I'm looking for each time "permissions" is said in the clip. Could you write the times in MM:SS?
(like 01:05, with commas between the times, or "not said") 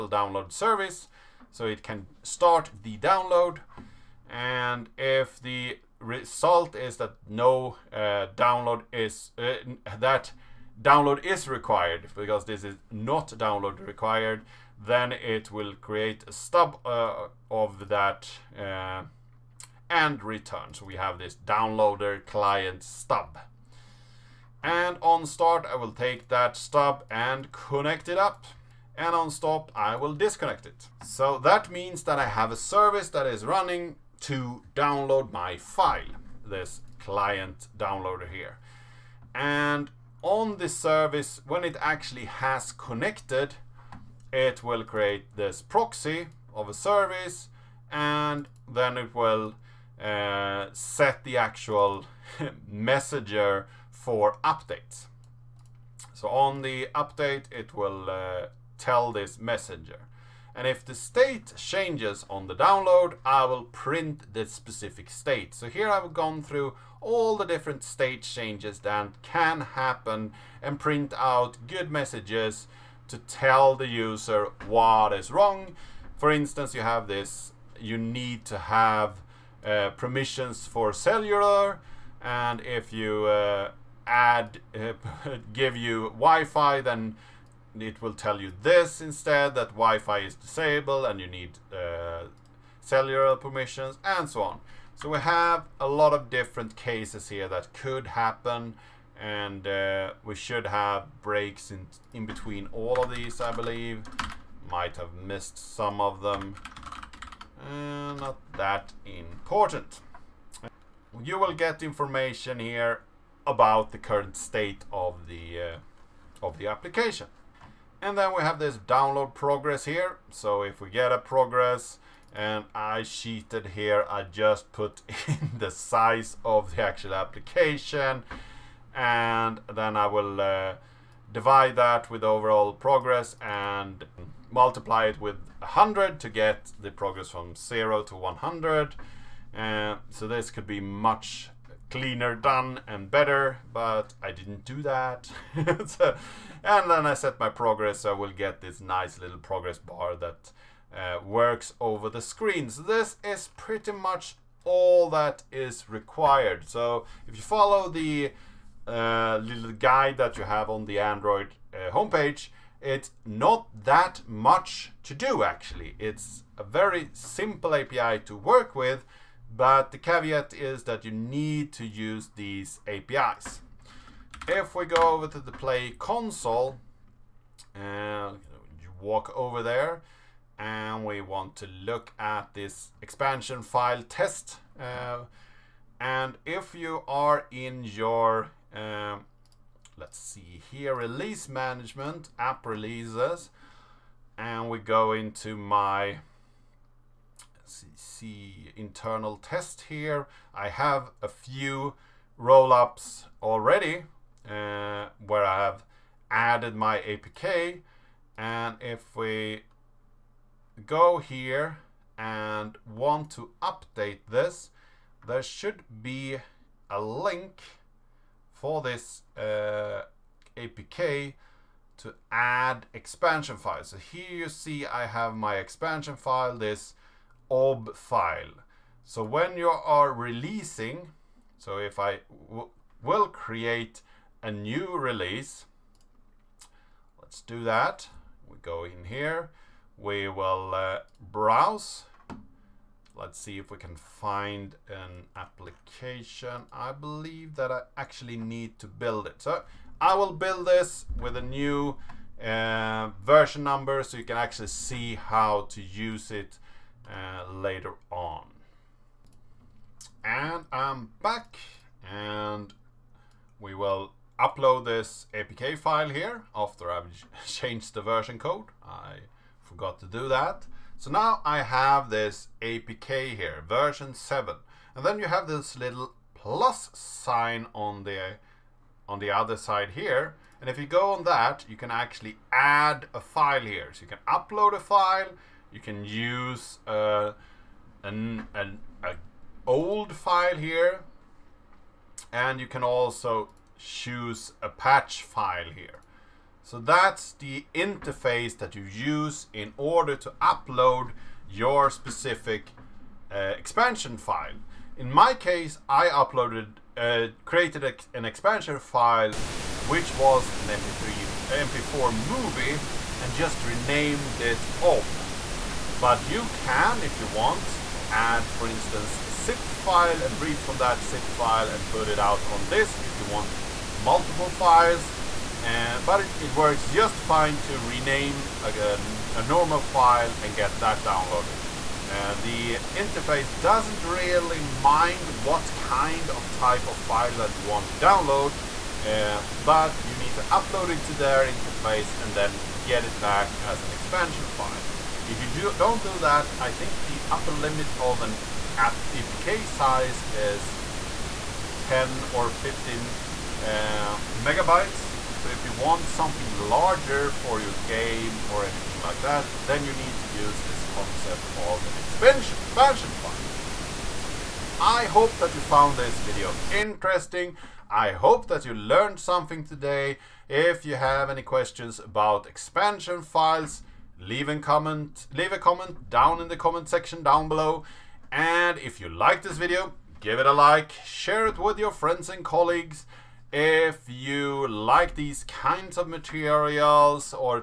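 01:19, 01:33.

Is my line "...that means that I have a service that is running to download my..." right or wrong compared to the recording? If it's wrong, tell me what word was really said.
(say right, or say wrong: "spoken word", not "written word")
right.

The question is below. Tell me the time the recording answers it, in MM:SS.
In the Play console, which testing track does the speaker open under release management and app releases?
03:18.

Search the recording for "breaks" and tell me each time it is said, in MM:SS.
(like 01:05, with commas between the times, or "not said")
01:41.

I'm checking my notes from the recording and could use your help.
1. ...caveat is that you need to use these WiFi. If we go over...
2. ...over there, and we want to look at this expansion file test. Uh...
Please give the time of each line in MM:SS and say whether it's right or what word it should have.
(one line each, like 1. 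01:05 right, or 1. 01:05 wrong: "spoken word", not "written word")
1. 02:49 wrong: "APIs", not "WiFi"
2. 02:59 right.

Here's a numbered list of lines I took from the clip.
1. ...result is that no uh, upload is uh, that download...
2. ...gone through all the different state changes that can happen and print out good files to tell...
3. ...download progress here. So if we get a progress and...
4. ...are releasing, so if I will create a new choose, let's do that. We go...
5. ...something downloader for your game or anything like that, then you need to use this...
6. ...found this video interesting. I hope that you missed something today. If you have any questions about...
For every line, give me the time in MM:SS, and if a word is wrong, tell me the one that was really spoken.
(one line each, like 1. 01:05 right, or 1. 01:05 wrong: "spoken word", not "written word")
1. 00:05 wrong: "download", not "upload"
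2. 01:06 wrong: "messages", not "files"
3. 01:58 right
4. 03:49 wrong: "release", not "choose"
5. 05:56 wrong: "larger", not "downloader"
6. 06:05 wrong: "learned", not "missed".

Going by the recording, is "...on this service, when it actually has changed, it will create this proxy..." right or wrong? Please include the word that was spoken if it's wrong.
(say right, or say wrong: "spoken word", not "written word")
wrong: "connected", not "changed".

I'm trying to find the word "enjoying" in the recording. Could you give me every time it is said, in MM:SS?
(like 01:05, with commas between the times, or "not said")
not said.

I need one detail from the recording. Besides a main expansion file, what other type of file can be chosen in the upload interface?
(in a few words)
patch file.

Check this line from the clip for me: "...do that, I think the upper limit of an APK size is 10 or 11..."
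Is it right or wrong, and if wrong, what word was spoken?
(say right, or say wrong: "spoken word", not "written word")
wrong: "15", not "11".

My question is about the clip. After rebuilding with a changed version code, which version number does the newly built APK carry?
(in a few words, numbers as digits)
7.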